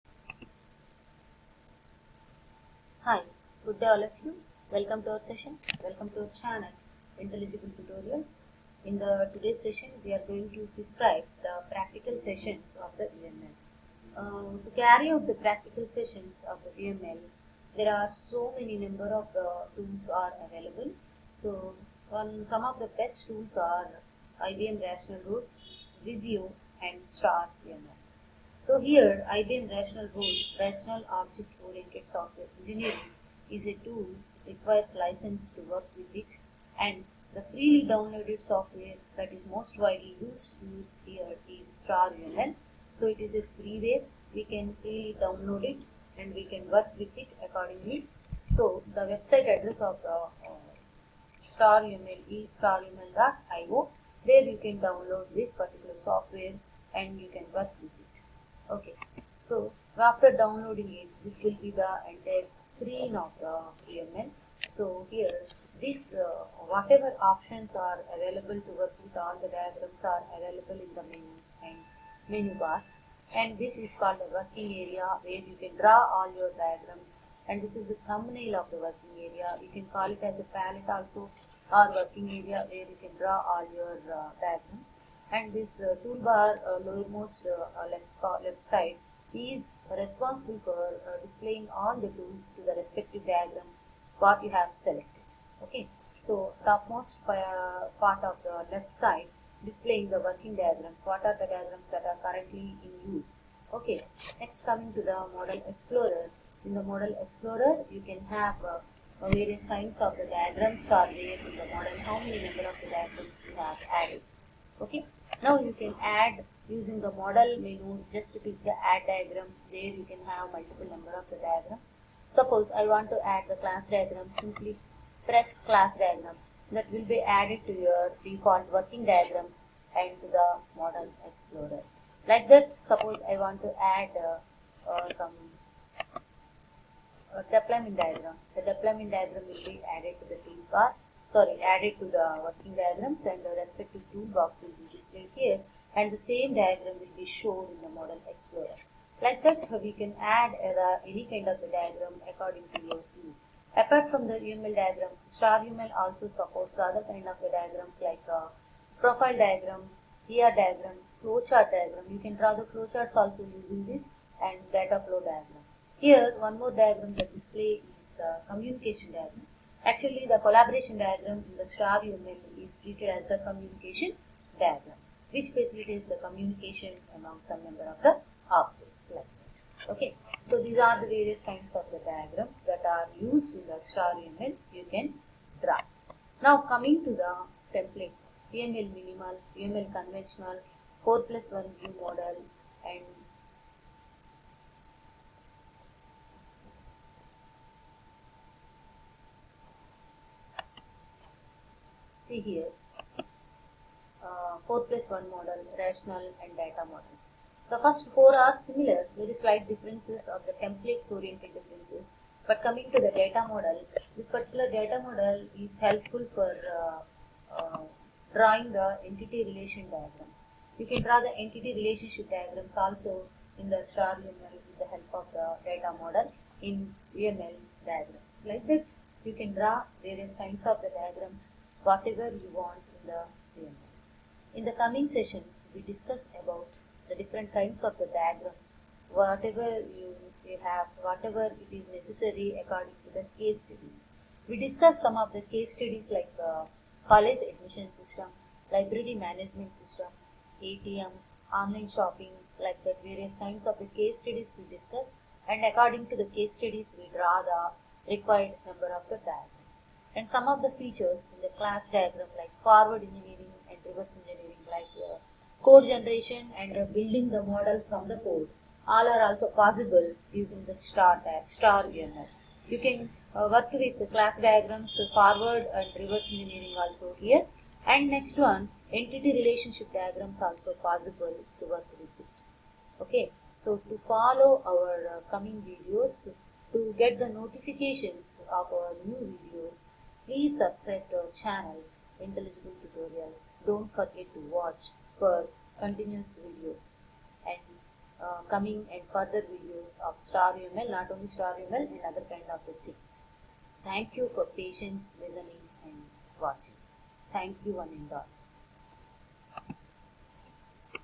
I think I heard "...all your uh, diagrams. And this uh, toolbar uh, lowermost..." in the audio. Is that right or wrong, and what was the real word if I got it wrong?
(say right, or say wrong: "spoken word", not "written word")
right.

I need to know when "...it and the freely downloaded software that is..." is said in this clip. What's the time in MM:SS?
00:36.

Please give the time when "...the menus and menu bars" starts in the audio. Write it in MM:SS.
01:10.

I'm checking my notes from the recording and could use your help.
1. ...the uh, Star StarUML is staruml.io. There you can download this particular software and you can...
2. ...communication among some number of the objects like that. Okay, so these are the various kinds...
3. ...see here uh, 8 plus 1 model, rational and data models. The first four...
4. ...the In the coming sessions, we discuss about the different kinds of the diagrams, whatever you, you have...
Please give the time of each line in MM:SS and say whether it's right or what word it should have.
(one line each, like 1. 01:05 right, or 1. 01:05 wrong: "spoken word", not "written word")
1. 00:50 right
2. 02:56 right
3. 03:22 wrong: "4", not "8"
4. 03:53 right.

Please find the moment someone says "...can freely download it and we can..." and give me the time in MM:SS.
00:44.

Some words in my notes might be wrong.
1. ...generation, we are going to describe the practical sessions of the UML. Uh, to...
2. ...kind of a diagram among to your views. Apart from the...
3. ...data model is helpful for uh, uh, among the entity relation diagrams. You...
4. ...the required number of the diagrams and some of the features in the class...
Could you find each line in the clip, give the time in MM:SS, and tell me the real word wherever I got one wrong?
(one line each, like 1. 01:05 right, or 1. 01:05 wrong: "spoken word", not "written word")
1. 00:09 wrong: "session", not "generation"
2. 02:31 wrong: "according", not "among"
3. 03:34 wrong: "drawing", not "among"
4. 04:17 right.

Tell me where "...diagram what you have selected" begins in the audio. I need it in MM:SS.
01:33.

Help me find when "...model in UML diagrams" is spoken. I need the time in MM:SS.
03:46.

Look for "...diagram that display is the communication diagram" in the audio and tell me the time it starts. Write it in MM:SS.
02:46.